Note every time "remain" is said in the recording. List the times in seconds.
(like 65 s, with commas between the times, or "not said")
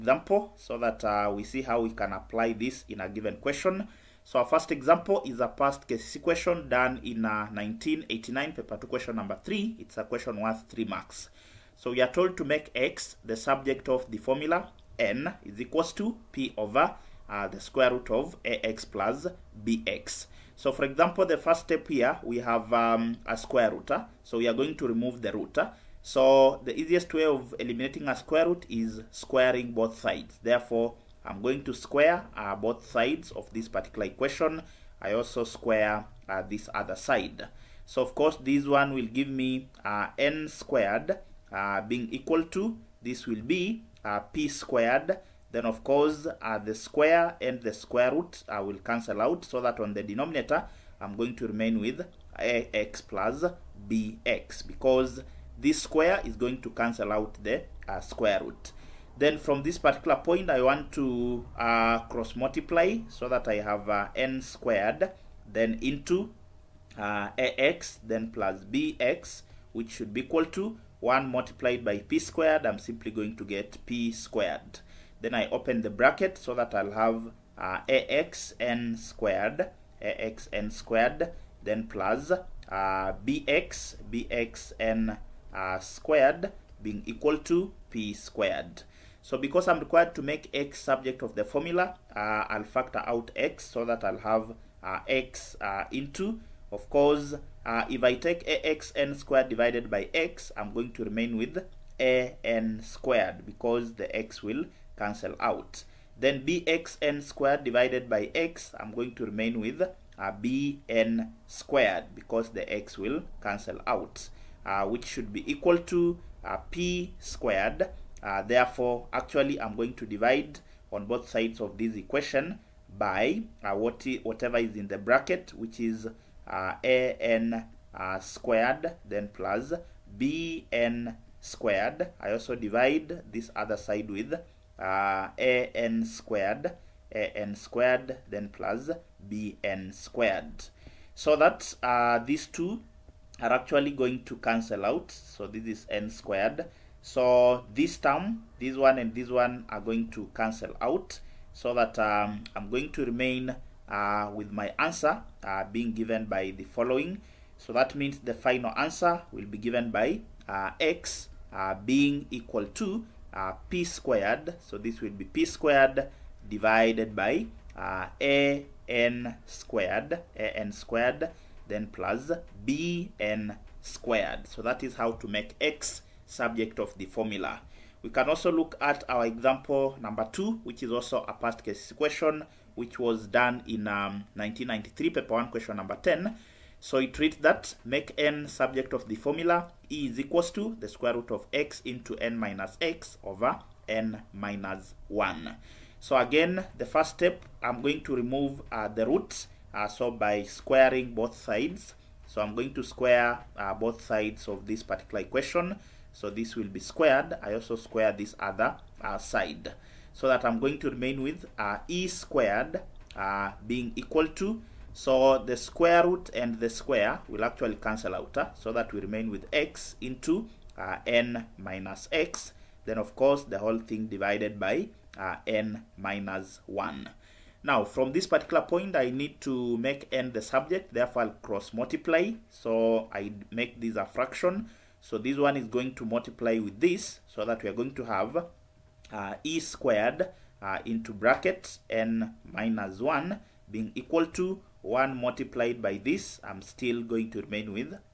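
51 s, 101 s, 109 s, 153 s, 210 s, 218 s, 247 s.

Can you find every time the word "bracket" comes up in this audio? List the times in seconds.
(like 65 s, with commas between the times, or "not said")
75 s, 124 s, 241 s.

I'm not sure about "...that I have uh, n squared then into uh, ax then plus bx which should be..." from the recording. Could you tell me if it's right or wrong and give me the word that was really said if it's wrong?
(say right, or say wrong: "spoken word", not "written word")
right.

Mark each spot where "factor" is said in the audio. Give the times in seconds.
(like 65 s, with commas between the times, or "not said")
92 s.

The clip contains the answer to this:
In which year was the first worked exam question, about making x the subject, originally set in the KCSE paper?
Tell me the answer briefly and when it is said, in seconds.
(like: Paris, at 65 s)
1989, at 7 s.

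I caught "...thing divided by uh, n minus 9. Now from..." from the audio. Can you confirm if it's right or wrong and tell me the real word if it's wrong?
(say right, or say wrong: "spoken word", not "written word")
wrong: "1", not "9".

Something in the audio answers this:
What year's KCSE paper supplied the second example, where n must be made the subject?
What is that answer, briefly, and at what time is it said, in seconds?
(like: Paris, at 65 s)
1993, at 184 s.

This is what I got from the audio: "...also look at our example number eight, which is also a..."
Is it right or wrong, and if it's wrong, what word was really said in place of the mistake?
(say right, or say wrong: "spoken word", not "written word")
wrong: "two", not "eight".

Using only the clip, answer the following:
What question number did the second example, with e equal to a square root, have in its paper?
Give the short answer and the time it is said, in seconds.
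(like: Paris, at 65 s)
10, at 185 s.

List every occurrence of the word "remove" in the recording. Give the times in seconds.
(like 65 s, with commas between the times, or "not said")
24 s, 198 s.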